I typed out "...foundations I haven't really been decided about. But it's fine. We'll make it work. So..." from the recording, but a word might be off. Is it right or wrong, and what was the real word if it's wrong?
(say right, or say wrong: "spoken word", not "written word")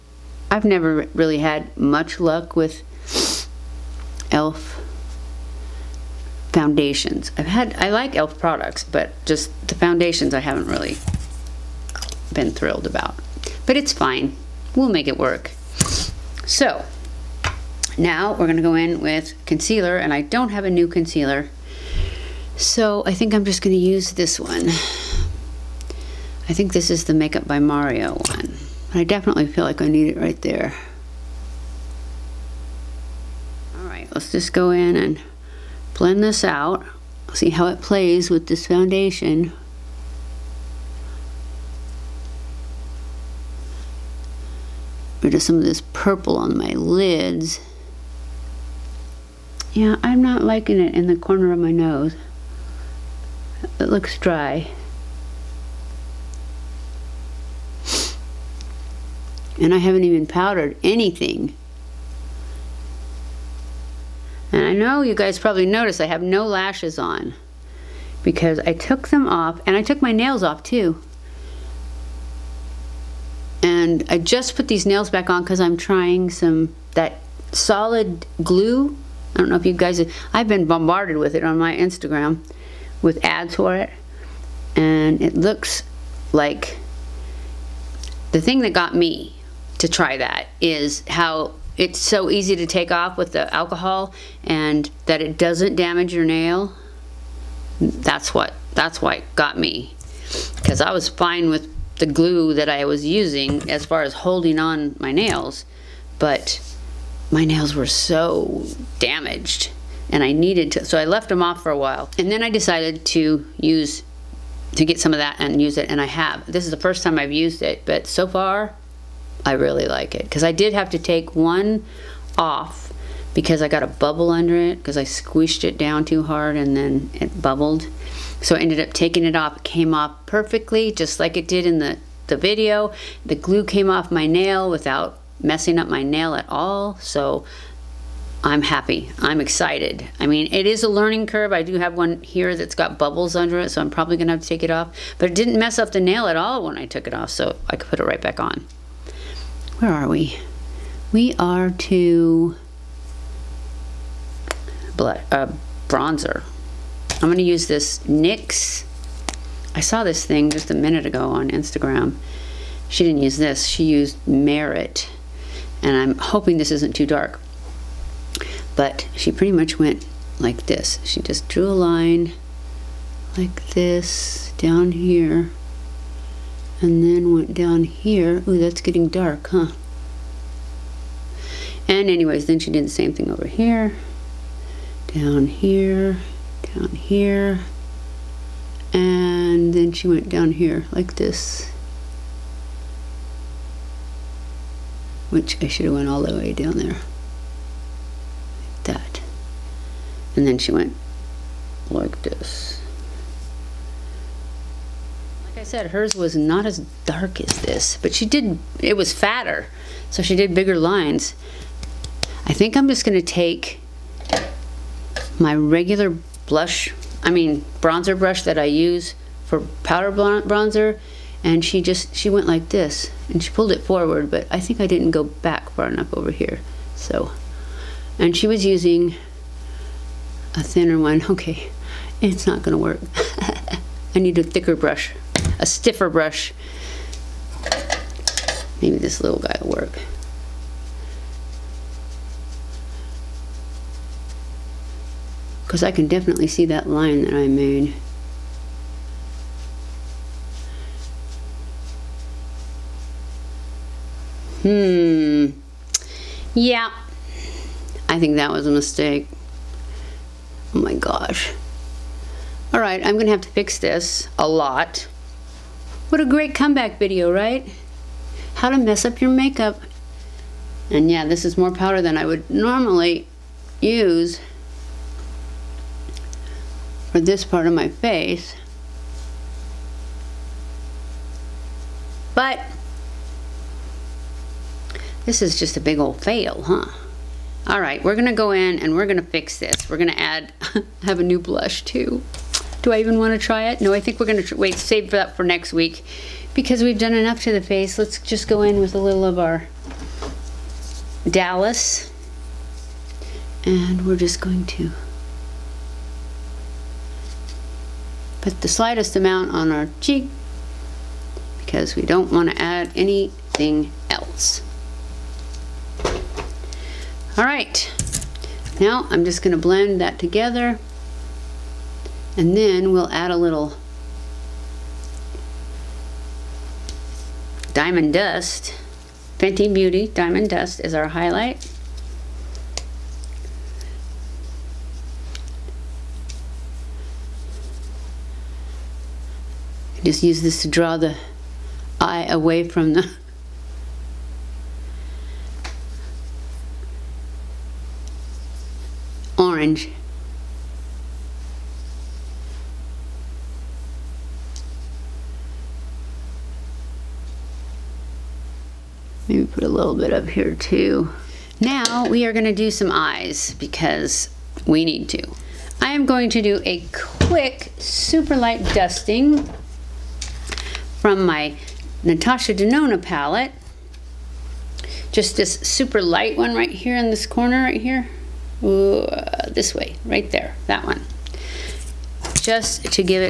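wrong: "thrilled", not "decided".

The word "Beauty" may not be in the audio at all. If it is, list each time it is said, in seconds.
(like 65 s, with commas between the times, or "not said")
329 s.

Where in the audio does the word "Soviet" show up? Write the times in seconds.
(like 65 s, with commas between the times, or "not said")
not said.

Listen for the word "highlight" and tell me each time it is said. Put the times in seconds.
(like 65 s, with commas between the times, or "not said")
331 s.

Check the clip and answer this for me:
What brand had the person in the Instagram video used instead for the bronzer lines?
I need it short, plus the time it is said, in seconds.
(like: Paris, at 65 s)
Merit, at 164 s.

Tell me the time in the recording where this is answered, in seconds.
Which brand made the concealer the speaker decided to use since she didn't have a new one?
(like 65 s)
27 s.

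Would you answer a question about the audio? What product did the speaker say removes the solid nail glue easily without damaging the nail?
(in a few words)
alcohol.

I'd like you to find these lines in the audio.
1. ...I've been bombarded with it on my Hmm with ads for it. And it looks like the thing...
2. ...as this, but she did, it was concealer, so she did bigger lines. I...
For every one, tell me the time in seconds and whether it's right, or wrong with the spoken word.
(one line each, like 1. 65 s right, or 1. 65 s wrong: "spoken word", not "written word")
1. 80 s wrong: "Instagram", not "Hmm"
2. 207 s wrong: "fatter", not "concealer".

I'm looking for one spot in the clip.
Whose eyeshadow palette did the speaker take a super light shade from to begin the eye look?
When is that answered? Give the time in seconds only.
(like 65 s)
372 s.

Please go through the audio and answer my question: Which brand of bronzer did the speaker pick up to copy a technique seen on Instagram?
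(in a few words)
NYX.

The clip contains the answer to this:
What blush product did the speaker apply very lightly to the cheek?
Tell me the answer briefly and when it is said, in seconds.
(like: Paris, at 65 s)
Dallas, at 301 s.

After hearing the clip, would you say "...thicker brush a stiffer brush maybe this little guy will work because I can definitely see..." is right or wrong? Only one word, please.
right.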